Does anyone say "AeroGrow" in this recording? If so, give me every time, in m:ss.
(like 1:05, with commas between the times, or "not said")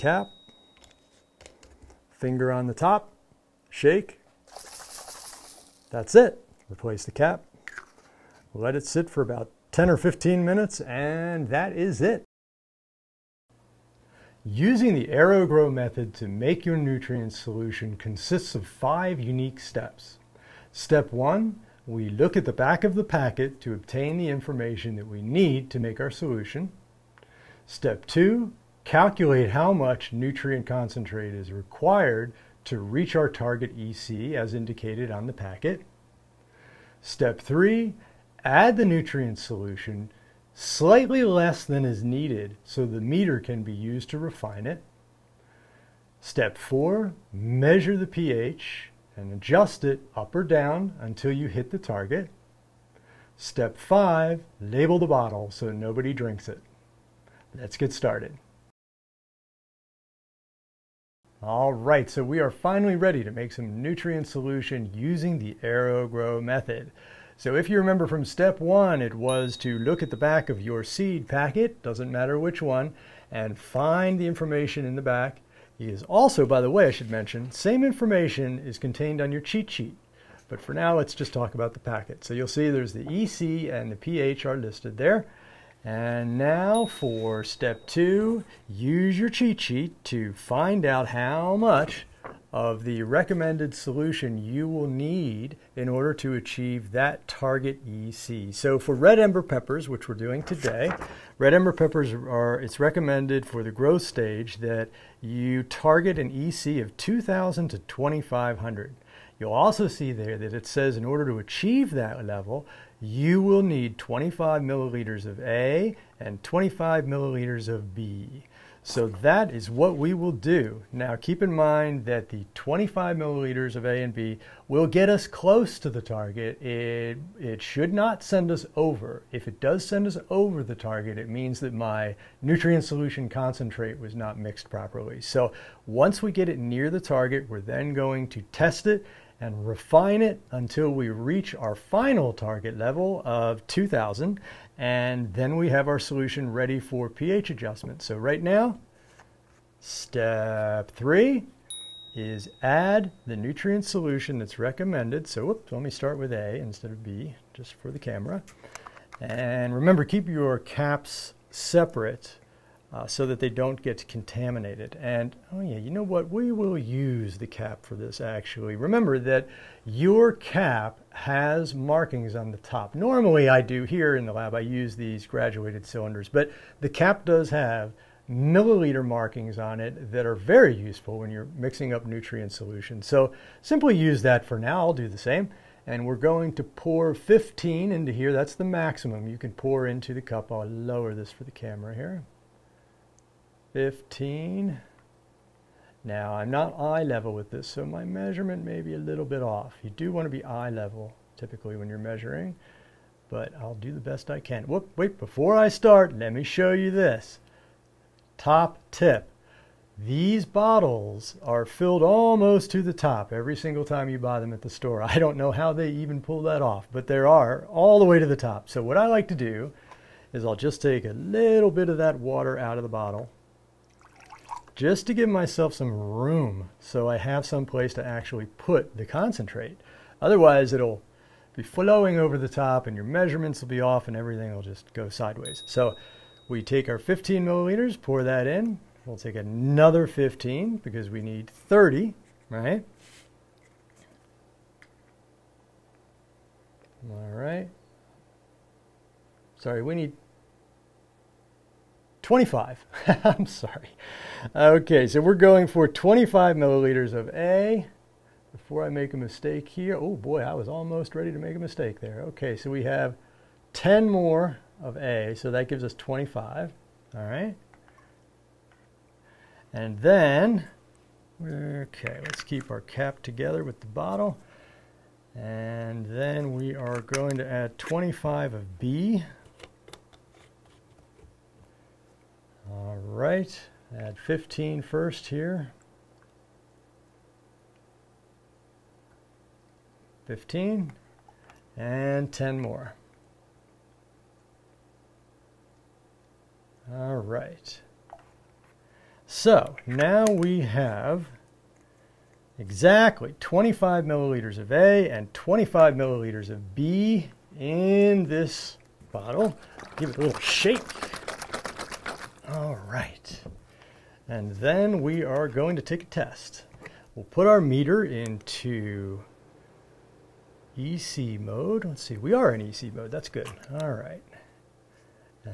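0:15, 1:05.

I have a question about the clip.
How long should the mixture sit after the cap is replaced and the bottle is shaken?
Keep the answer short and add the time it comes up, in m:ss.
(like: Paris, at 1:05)
10 or 15 minutes, at 0:09.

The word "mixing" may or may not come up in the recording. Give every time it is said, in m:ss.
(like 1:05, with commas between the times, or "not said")
3:01.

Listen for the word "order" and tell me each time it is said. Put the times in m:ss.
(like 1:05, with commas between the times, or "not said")
1:35, 1:51.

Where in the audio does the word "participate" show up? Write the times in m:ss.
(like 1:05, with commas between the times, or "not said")
not said.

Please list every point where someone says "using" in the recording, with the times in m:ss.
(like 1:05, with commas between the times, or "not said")
0:14, 1:04.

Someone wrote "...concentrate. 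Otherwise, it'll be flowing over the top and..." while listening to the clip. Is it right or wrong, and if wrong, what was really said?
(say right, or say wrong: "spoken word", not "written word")
right.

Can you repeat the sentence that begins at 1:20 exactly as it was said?
But for now, let's just talk about the packet.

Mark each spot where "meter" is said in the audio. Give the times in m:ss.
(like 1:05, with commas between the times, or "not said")
0:43, 5:17.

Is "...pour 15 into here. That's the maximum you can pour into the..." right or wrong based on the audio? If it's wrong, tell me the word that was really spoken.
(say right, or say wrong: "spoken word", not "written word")
right.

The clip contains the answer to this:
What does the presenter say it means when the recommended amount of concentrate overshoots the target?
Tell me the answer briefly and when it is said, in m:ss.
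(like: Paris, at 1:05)
Not mixed properly, at 2:14.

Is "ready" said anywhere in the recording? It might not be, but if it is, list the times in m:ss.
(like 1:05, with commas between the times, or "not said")
1:02, 2:26, 4:21.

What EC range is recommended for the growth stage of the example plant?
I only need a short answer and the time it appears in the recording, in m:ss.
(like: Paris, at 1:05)
2,000 to 2,500, at 1:46.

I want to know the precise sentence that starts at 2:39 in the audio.
And remember, keep your caps separate uh, so that they don't get contaminated.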